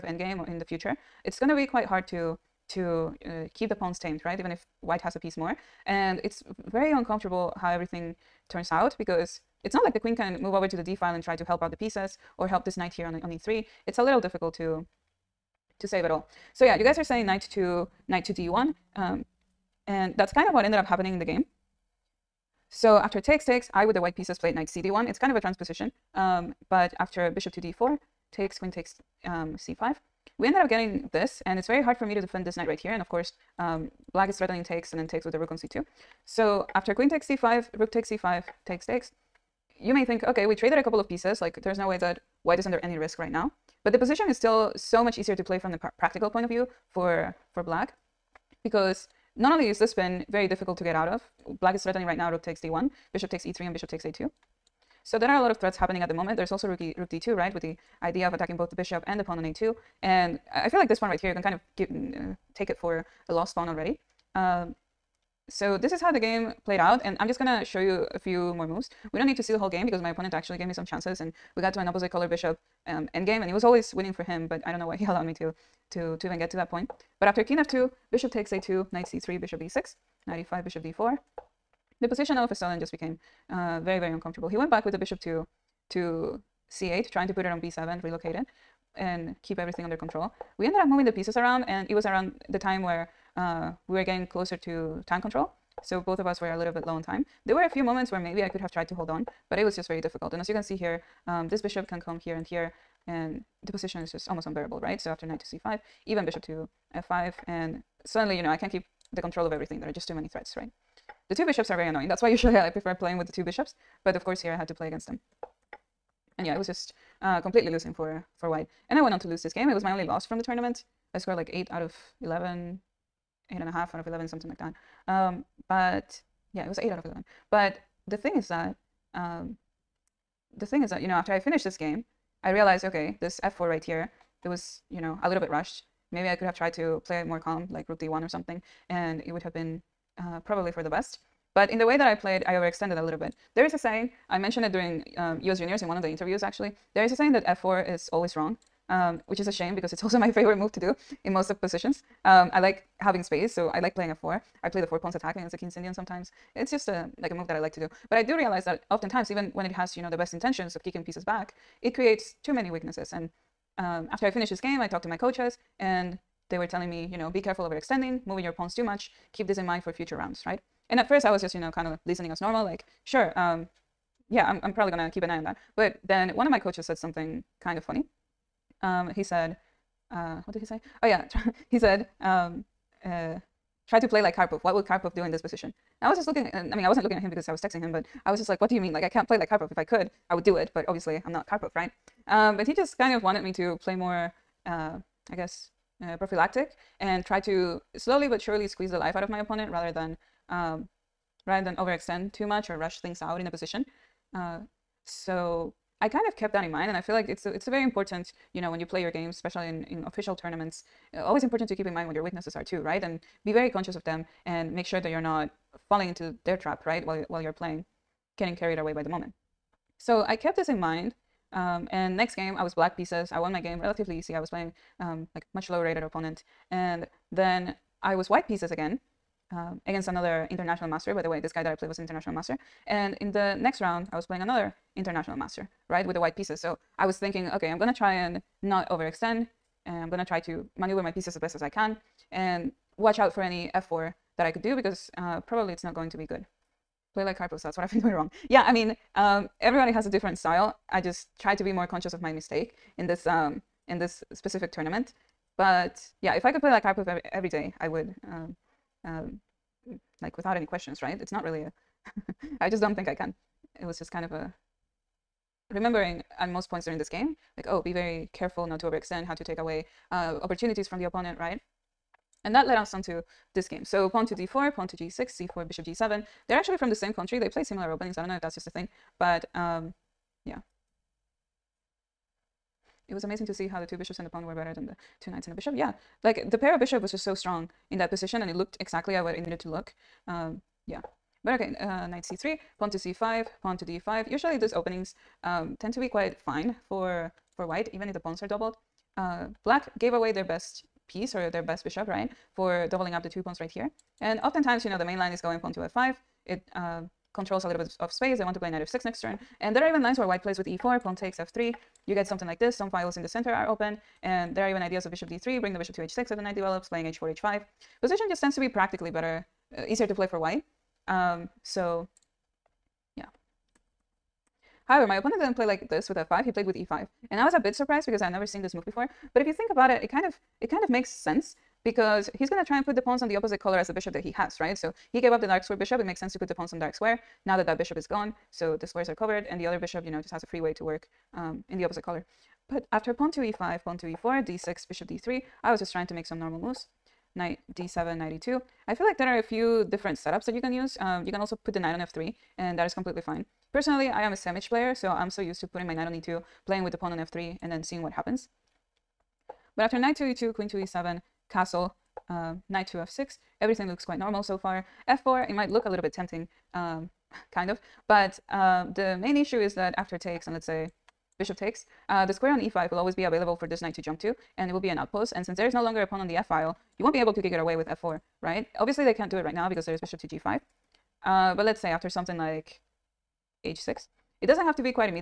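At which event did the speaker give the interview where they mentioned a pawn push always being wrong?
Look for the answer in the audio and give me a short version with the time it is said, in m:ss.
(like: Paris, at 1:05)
US Juniors, at 2:25.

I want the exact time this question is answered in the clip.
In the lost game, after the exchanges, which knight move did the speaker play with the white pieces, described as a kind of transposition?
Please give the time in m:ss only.
0:24.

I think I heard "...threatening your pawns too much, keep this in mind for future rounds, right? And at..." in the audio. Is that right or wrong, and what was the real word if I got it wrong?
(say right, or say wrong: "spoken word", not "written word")
wrong: "moving", not "threatening".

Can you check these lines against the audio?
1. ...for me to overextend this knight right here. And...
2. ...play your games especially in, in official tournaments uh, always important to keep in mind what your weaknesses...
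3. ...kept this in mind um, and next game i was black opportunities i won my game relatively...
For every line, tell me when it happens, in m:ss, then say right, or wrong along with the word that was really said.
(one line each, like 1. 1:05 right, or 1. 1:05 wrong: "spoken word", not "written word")
1. 0:31 wrong: "defend", not "overextend"
2. 3:28 right
3. 3:40 wrong: "pieces", not "opportunities".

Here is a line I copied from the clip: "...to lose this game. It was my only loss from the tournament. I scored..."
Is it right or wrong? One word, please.
right.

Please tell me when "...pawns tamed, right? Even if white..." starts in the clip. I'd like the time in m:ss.
0:03.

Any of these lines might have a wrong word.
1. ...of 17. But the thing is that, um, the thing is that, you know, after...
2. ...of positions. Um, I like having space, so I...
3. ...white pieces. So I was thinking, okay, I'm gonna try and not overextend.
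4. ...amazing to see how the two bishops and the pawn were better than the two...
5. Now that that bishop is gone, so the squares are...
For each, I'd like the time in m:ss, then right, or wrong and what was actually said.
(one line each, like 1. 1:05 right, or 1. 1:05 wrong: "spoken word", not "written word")
1. 2:06 wrong: "11", not "17"
2. 2:31 right
3. 3:56 right
4. 4:43 right
5. 5:37 right.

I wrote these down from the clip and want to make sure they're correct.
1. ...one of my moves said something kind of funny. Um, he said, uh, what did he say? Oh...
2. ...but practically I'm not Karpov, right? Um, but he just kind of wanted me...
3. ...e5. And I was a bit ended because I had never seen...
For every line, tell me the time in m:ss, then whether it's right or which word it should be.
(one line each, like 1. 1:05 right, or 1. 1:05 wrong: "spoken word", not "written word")
1. 2:56 wrong: "coaches", not "moves"
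2. 3:10 wrong: "obviously", not "practically"
3. 5:26 wrong: "surprised", not "ended".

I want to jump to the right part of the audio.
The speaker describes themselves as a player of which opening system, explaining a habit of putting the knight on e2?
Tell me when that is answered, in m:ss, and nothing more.
5:54.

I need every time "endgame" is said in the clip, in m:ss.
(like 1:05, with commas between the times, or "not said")
0:00, 1:13.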